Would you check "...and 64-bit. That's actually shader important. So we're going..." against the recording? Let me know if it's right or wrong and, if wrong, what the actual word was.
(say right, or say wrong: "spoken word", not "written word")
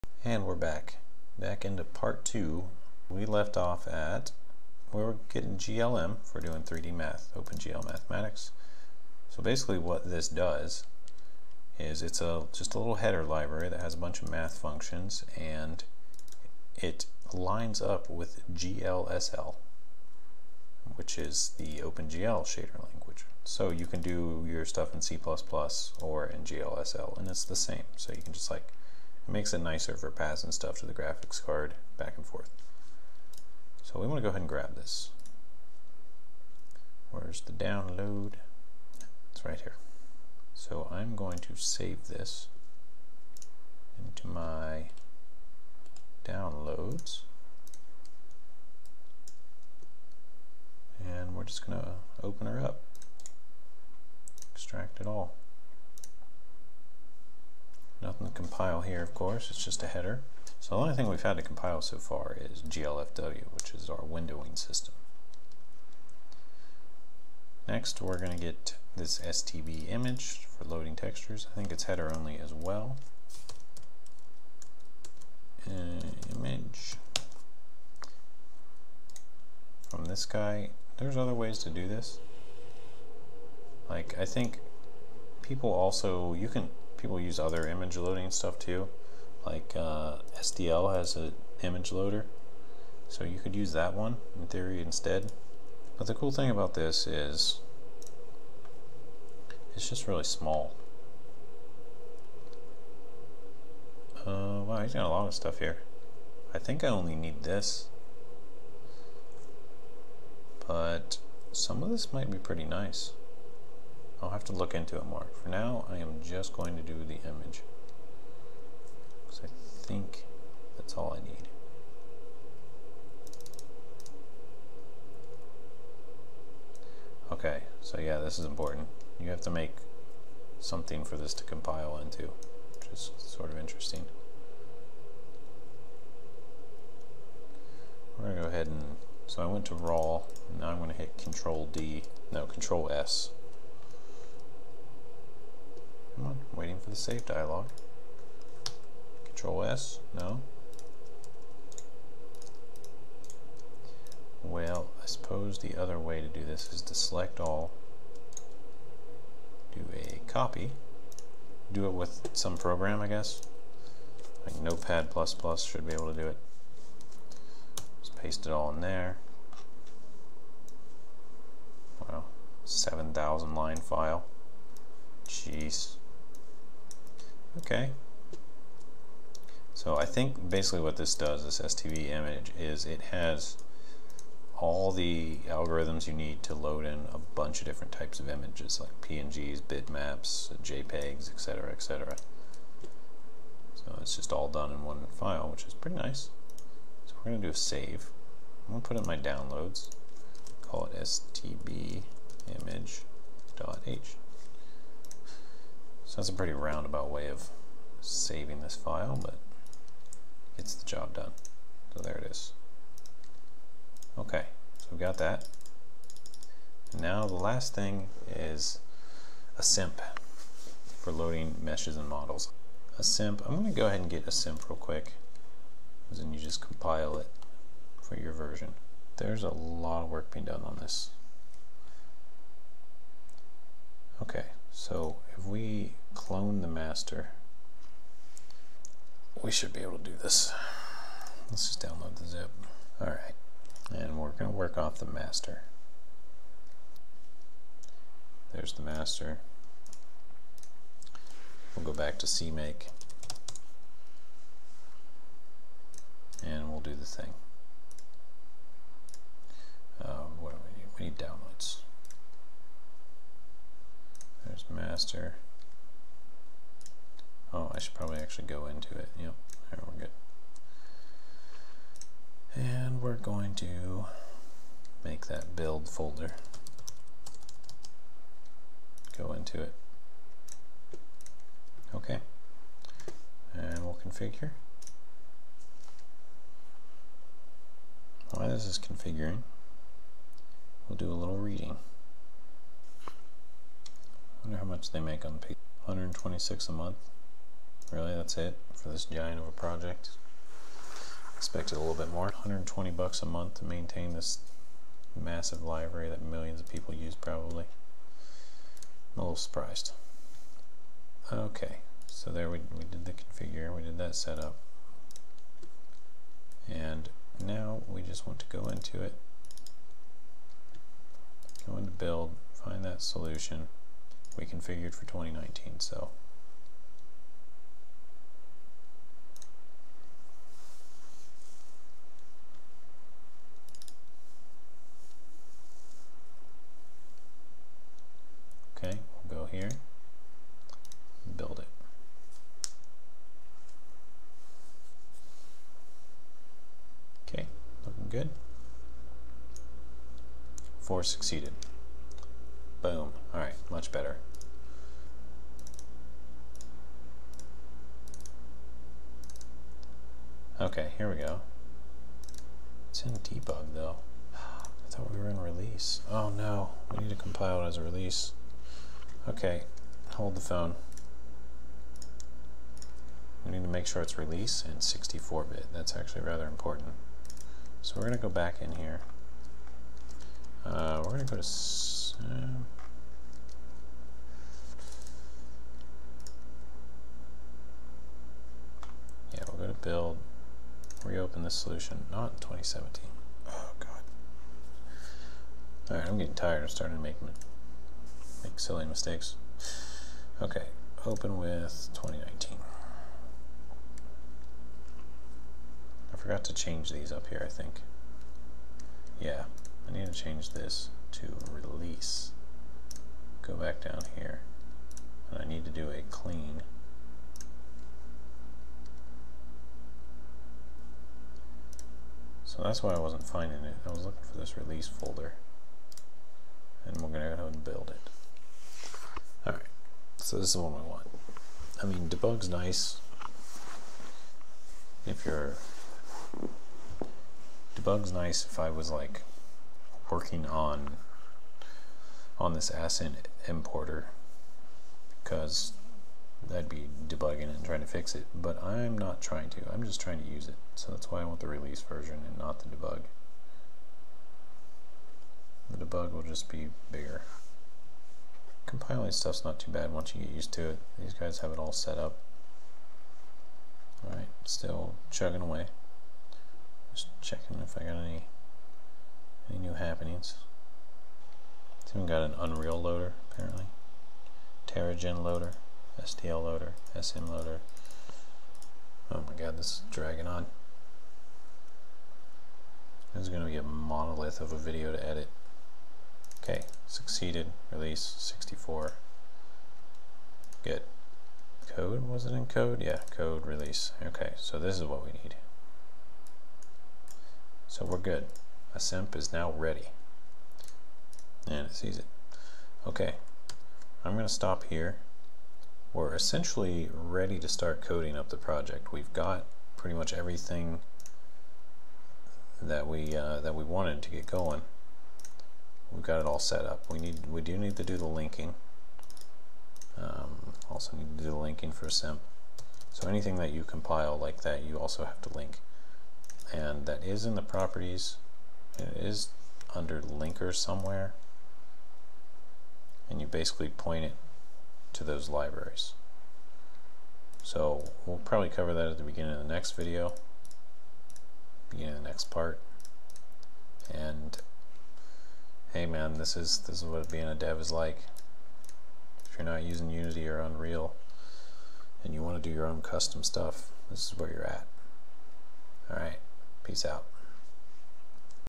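wrong: "rather", not "shader".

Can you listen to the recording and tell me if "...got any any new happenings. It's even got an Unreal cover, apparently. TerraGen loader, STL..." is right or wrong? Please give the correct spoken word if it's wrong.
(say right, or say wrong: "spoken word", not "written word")
wrong: "loader", not "cover".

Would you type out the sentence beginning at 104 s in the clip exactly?
Uh, wow, he's got a lot of stuff here.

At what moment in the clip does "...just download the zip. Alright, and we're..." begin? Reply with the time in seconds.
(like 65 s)
241 s.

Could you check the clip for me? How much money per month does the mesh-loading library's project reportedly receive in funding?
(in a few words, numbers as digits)
120 bucks.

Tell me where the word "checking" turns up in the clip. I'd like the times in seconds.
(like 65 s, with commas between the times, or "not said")
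467 s.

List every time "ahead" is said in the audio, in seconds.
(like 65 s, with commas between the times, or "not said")
34 s, 138 s, 223 s, 427 s.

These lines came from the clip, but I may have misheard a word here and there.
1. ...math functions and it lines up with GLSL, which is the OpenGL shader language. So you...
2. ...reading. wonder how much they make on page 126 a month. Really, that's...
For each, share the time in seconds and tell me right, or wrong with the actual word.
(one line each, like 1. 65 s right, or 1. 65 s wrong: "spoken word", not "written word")
1. 14 s right
2. 291 s right.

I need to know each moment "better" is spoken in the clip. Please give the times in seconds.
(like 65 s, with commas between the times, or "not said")
353 s.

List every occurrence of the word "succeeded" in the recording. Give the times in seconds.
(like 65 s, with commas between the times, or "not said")
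351 s, 486 s.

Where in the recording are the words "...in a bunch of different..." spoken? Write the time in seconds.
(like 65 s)
186 s.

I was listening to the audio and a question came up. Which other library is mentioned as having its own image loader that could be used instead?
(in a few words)
SDL.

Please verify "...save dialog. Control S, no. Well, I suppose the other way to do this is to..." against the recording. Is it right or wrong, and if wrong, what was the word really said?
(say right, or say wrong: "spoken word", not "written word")
right.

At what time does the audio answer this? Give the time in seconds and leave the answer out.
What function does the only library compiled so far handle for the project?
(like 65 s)
63 s.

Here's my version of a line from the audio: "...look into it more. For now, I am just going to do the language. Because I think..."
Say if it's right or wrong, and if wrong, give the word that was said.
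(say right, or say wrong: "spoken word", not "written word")
wrong: "image", not "language".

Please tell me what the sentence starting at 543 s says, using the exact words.
And hey man, this is this is what being a dev is like.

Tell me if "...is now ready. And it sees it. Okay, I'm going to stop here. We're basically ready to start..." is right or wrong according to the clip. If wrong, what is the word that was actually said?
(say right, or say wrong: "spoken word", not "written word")
wrong: "essentially", not "basically".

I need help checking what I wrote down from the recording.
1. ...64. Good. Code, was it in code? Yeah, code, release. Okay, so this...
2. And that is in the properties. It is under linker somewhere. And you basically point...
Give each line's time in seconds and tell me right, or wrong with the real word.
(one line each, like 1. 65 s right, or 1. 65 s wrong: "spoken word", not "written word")
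1. 488 s right
2. 526 s right.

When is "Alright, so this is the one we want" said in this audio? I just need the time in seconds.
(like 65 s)
429 s.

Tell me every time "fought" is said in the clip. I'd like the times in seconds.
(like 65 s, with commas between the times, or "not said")
not said.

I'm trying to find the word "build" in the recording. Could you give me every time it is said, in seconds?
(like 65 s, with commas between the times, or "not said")
275 s, 321 s, 341 s, 389 s, 427 s.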